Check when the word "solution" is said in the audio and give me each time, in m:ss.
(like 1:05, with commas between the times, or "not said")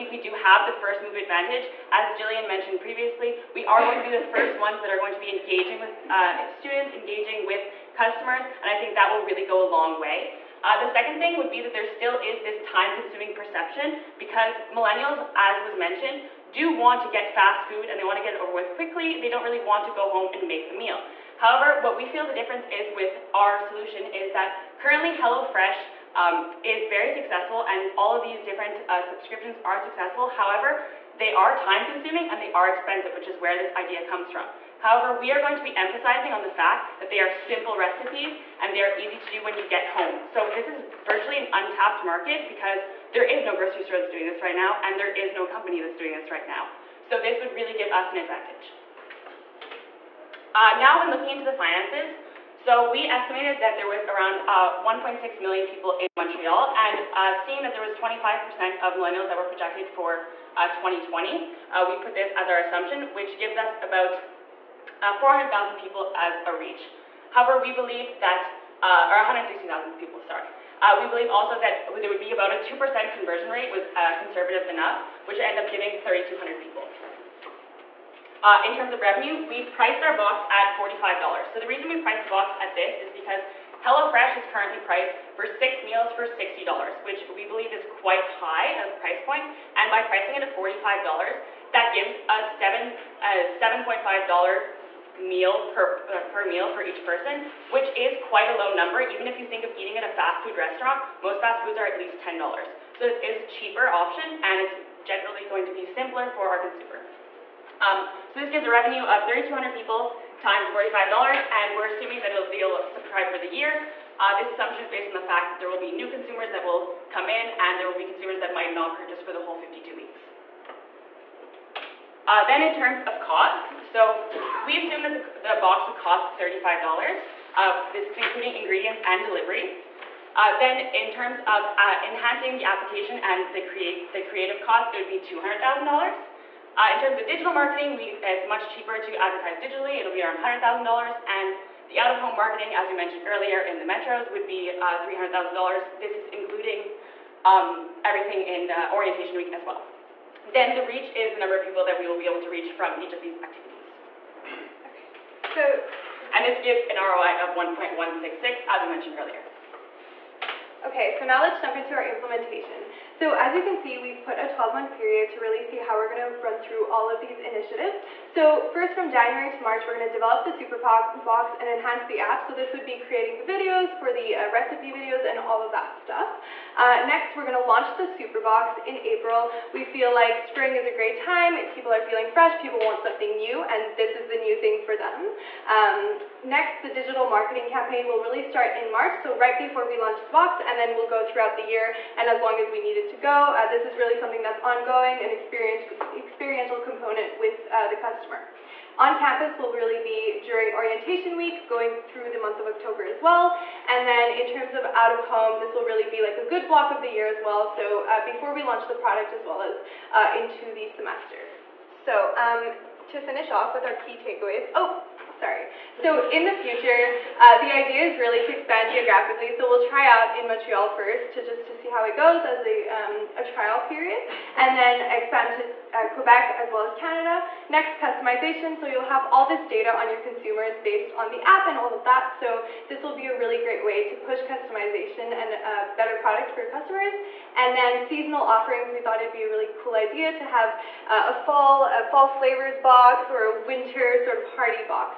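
0:23.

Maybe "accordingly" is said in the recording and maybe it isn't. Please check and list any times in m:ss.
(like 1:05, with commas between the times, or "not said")
not said.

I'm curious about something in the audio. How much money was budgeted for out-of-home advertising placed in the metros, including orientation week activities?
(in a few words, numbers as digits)
$300,000.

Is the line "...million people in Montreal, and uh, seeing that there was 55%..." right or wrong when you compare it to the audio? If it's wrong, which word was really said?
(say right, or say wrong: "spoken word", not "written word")
wrong: "25", not "55".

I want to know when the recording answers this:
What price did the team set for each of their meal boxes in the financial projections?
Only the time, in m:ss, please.
1:19.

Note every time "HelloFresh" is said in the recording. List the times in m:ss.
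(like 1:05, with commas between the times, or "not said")
0:25, 1:23.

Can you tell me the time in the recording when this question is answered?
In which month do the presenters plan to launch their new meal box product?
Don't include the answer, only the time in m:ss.
2:58.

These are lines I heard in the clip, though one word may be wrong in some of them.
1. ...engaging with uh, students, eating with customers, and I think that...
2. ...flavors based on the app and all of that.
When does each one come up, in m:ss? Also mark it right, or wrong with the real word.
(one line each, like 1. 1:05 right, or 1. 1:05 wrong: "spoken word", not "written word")
1. 0:05 wrong: "engaging", not "eating"
2. 3:50 wrong: "consumers", not "flavors".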